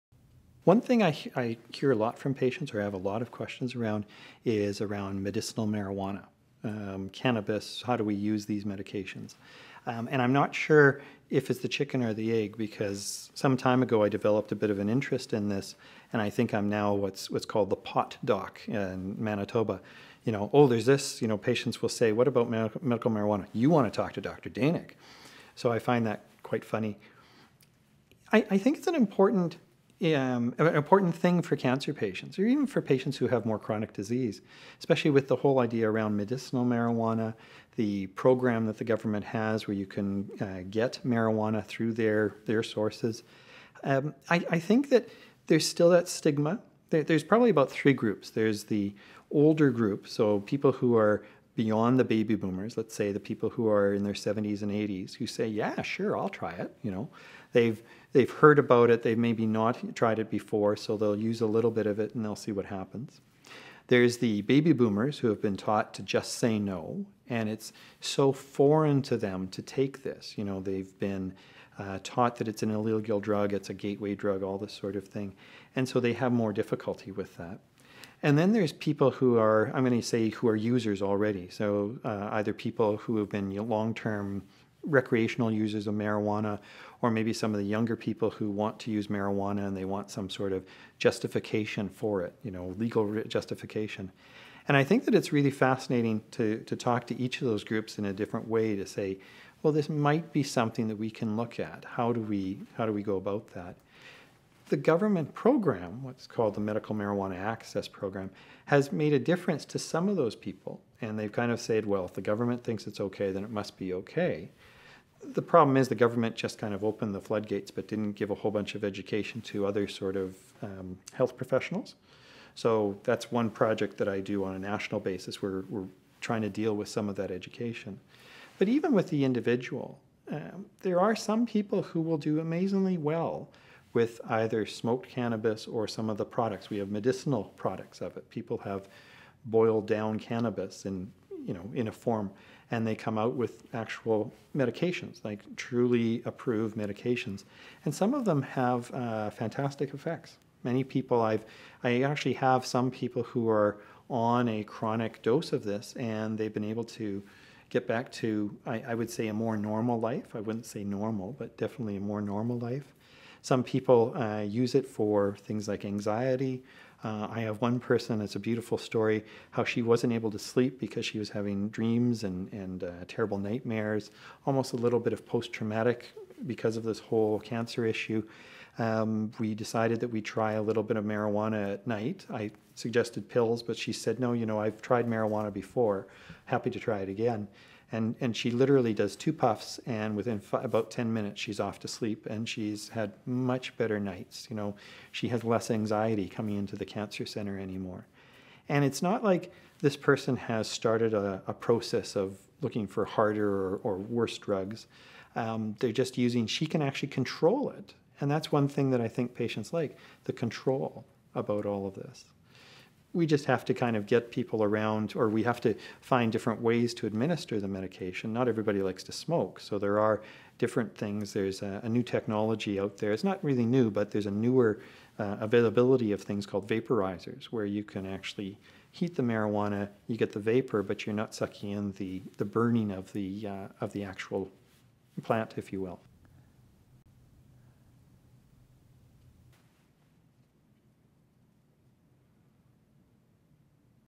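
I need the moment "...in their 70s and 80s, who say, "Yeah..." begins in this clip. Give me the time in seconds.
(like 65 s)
53 s.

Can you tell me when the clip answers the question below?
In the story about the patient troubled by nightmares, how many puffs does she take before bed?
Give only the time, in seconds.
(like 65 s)
189 s.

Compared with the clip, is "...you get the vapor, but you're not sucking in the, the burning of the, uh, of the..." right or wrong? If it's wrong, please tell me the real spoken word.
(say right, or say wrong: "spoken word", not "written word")
right.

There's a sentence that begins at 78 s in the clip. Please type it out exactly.
And then there's people who are, I'm going to say, who are users already.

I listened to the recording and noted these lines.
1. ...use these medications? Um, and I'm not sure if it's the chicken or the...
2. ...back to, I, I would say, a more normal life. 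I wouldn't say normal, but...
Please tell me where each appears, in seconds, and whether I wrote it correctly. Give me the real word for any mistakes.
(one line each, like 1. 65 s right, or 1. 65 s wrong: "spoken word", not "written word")
1. 8 s right
2. 157 s right.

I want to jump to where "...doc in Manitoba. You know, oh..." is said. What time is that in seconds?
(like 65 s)
18 s.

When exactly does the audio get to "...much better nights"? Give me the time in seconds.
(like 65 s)
193 s.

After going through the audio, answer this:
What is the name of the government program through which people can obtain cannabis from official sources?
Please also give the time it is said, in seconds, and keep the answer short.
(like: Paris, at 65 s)
Medical Marijuana Access Program, at 106 s.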